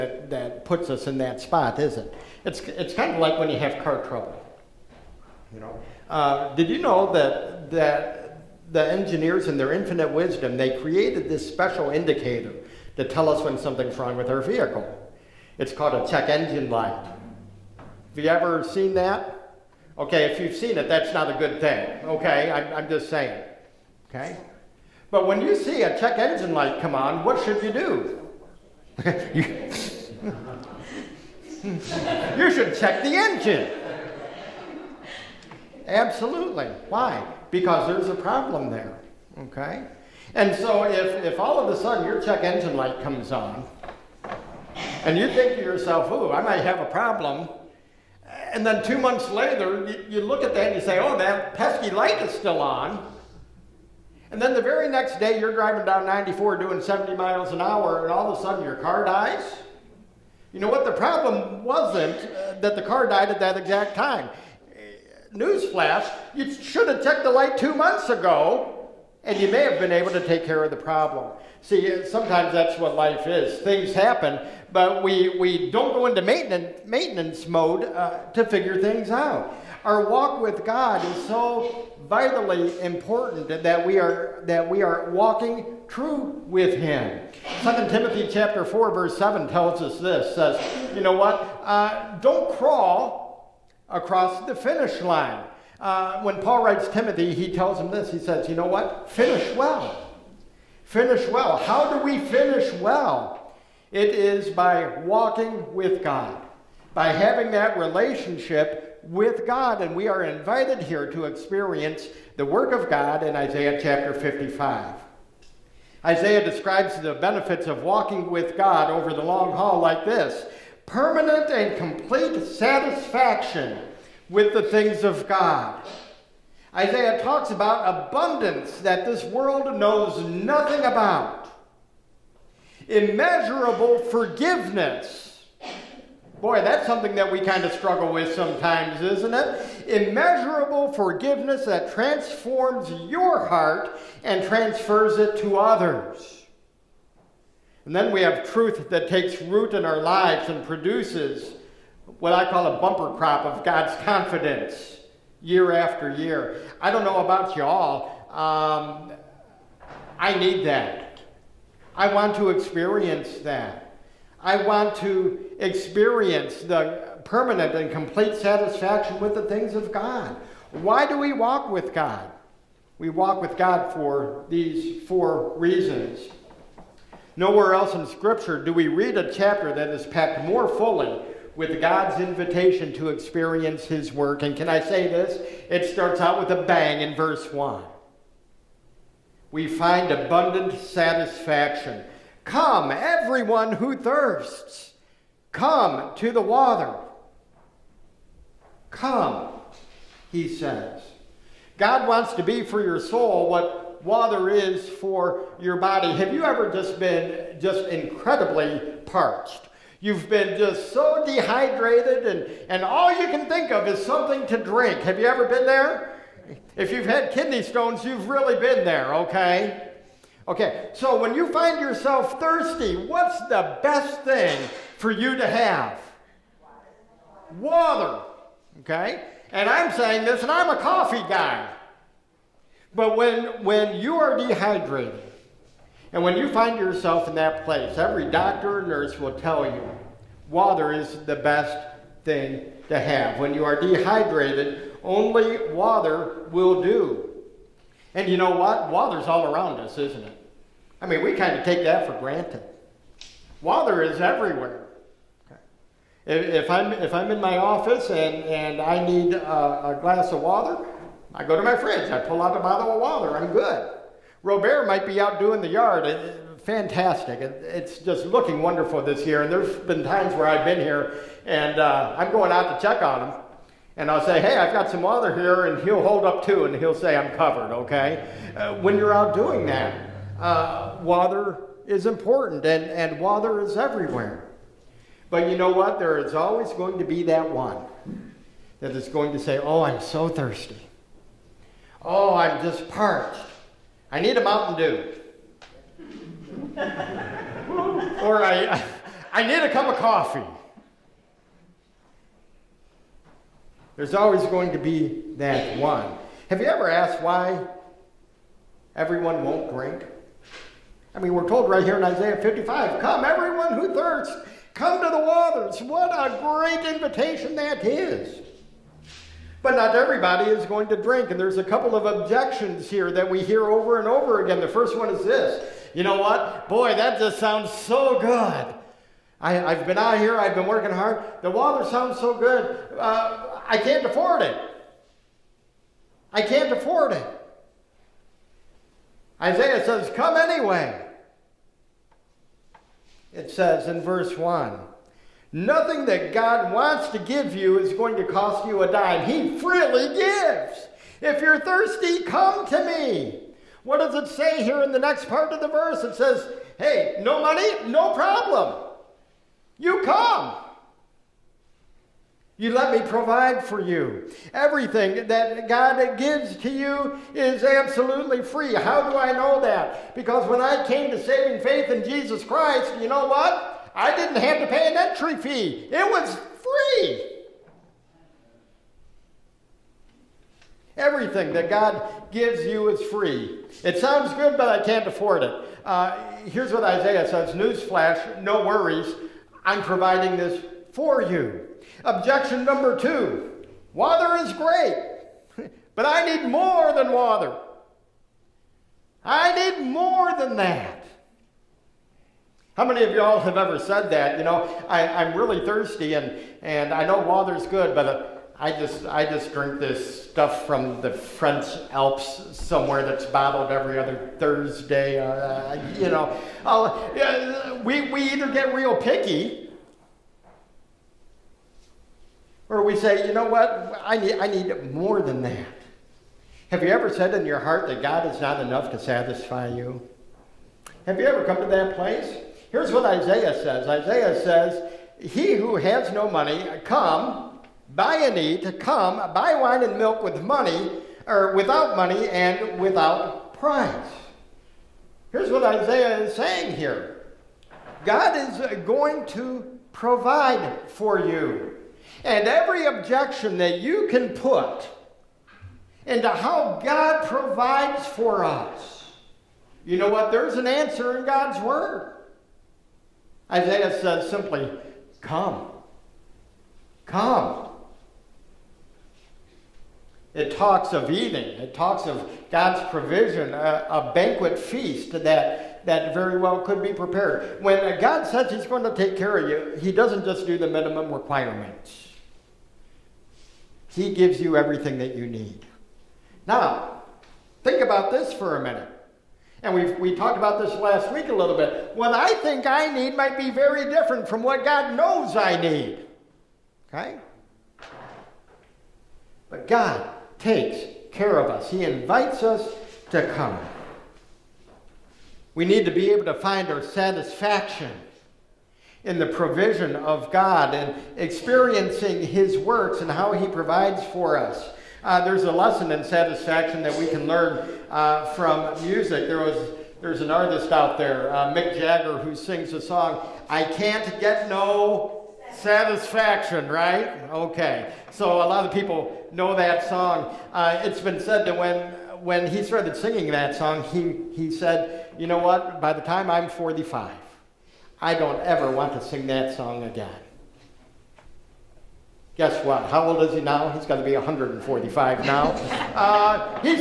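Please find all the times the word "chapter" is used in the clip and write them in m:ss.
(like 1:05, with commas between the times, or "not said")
1:28, 1:53, 2:59.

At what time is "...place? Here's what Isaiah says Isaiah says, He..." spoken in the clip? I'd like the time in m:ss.
7:11.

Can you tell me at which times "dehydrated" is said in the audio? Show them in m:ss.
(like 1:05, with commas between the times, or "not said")
3:31, 3:54, 4:03.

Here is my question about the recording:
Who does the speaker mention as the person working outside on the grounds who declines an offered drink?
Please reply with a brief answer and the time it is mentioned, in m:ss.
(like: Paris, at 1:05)
Robert, at 4:24.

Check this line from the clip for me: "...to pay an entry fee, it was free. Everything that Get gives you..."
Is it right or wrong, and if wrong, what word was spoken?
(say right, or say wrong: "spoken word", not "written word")
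wrong: "God", not "Get".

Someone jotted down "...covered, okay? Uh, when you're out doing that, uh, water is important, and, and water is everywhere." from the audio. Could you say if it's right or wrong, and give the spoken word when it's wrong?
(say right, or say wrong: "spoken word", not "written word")
right.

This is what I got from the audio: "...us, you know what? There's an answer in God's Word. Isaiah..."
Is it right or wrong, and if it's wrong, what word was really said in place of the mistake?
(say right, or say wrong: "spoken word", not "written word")
right.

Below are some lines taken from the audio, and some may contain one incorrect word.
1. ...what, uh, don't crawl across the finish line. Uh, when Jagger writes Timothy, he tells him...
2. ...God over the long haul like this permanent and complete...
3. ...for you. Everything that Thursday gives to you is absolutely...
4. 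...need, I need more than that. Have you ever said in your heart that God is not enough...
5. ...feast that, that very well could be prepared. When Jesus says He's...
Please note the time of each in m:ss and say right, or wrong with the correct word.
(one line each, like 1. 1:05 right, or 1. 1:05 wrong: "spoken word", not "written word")
1. 1:31 wrong: "Paul", not "Jagger"
2. 1:58 right
3. 6:03 wrong: "God", not "Thursday"
4. 7:04 right
5. 7:54 wrong: "God", not "Jesus".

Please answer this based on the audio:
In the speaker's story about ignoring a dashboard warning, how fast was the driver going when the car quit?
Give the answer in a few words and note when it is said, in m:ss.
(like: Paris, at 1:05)
70 miles an hour, at 0:56.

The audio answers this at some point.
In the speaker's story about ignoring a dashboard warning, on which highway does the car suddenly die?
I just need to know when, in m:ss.
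0:56.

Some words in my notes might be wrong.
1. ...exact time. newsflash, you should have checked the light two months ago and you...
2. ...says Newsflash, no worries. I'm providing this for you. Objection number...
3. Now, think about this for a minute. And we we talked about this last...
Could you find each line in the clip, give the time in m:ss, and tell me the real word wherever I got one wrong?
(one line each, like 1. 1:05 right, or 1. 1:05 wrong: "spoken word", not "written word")
1. 1:03 right
2. 6:27 right
3. 8:06 right.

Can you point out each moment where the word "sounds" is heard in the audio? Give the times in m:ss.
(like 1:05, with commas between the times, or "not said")
5:27, 5:31, 6:23.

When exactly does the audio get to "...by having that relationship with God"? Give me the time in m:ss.
1:46.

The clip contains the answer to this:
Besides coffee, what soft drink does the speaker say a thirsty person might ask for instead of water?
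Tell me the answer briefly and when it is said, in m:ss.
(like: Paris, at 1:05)
Mountain Dew, at 4:54.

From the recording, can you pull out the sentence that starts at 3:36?
If you've had kidney stones, you've really been there, okay?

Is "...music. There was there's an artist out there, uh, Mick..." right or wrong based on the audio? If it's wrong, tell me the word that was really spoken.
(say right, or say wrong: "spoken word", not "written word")
right.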